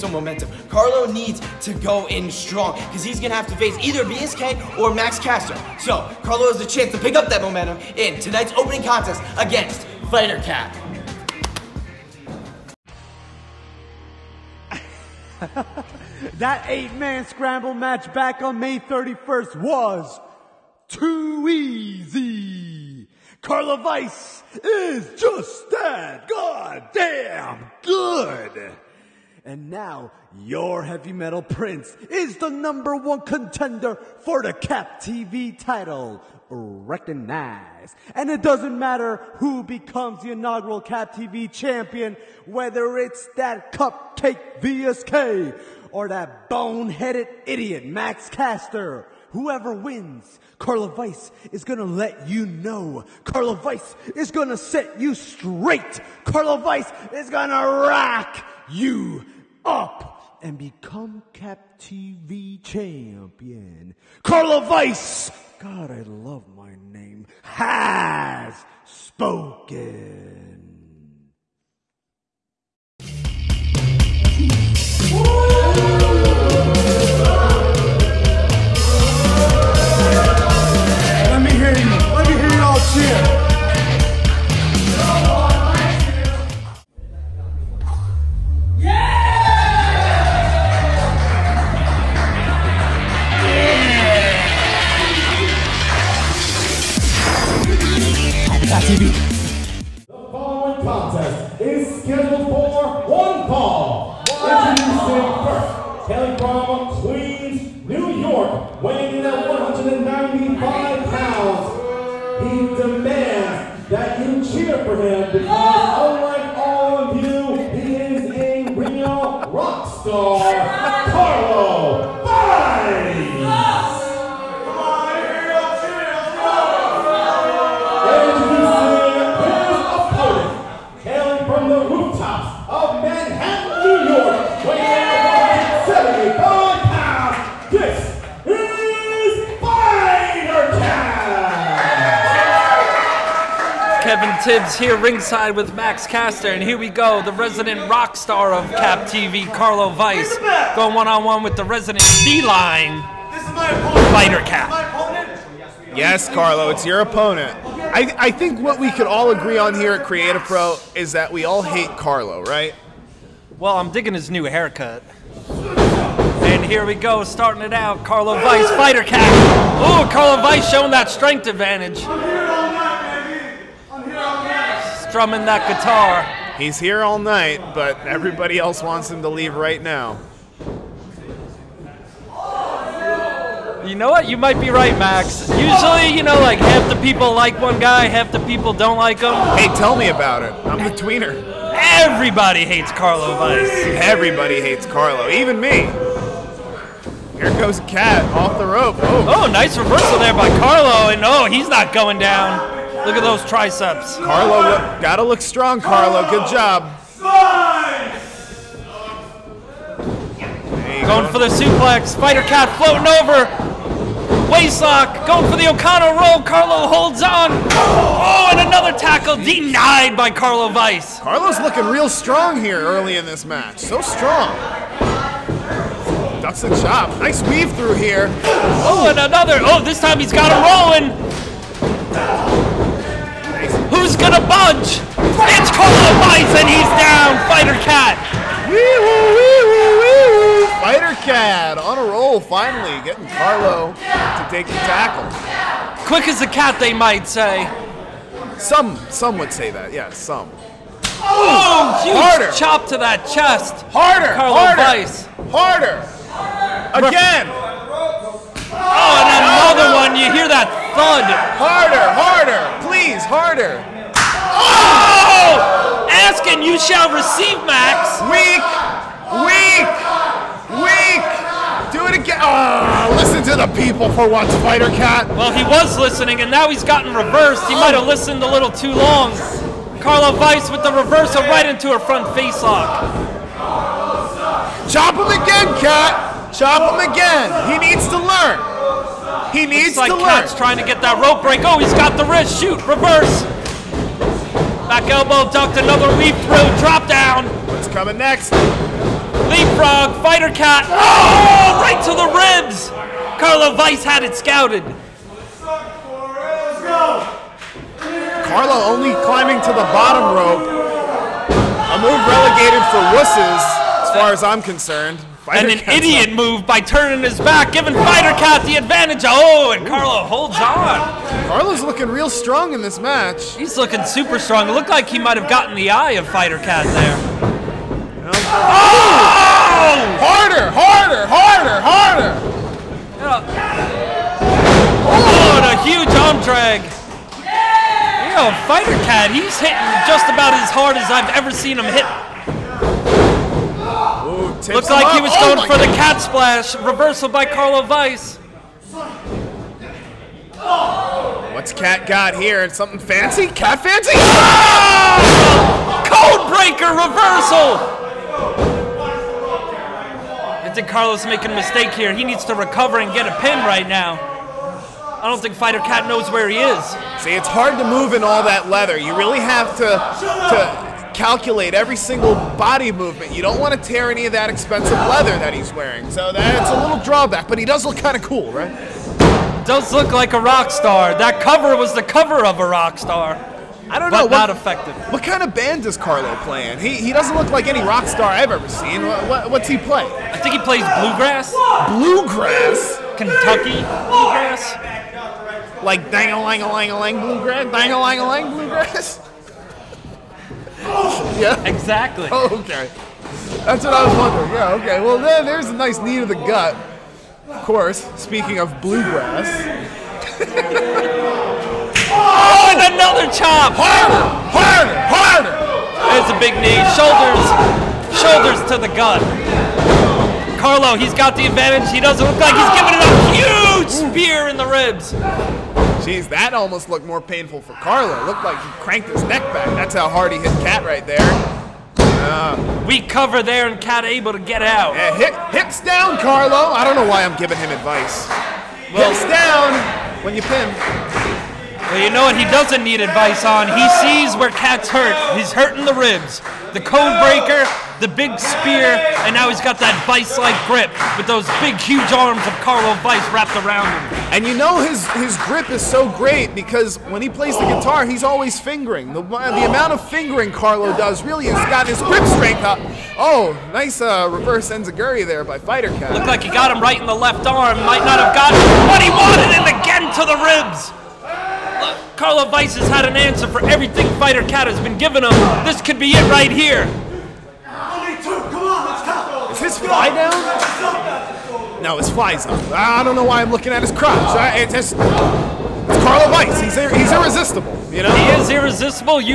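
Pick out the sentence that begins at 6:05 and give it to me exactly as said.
I don't think Fighter Cat knows where he is.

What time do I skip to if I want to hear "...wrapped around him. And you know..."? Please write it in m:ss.
7:33.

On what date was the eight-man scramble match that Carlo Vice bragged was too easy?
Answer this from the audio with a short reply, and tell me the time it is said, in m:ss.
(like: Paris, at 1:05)
May 31st, at 0:18.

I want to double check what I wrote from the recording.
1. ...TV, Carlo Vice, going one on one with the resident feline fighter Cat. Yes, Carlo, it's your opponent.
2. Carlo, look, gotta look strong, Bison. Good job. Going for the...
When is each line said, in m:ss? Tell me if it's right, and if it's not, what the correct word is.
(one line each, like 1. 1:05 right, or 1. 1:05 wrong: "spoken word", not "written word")
1. 2:29 right
2. 3:24 wrong: "Carlo", not "Bison".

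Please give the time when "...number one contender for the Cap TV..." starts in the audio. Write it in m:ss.
0:32.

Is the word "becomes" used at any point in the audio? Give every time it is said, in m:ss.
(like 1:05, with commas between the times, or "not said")
0:39, 1:00.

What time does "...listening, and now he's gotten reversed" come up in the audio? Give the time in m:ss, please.
4:35.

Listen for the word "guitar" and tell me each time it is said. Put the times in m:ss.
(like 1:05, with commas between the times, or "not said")
2:55, 7:37.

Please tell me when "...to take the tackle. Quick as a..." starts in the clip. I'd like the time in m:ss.
4:03.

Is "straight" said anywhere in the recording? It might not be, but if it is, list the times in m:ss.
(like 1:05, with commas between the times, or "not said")
0:55.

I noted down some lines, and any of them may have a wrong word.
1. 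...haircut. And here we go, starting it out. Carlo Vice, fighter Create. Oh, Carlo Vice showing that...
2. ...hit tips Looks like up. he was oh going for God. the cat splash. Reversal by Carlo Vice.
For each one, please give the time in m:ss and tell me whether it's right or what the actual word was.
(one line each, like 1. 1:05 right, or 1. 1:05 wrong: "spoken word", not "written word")
1. 2:44 wrong: "Cat", not "Create"
2. 5:41 right.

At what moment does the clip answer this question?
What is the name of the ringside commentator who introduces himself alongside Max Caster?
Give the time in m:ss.
2:24.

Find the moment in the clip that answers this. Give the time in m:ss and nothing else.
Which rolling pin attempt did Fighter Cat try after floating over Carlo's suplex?
3:35.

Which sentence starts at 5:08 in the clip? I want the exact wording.
Carlo only climbing to the bottom rope.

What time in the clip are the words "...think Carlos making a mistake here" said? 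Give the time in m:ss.
6:00.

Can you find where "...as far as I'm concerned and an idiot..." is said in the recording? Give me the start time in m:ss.
5:13.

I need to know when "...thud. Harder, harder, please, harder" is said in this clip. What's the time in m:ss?
4:20.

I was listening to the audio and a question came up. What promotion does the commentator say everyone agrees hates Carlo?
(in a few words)
Create A Pro.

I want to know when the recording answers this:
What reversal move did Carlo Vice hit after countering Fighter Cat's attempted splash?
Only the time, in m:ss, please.
5:56.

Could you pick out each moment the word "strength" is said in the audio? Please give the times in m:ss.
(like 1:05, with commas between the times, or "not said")
2:51, 7:42.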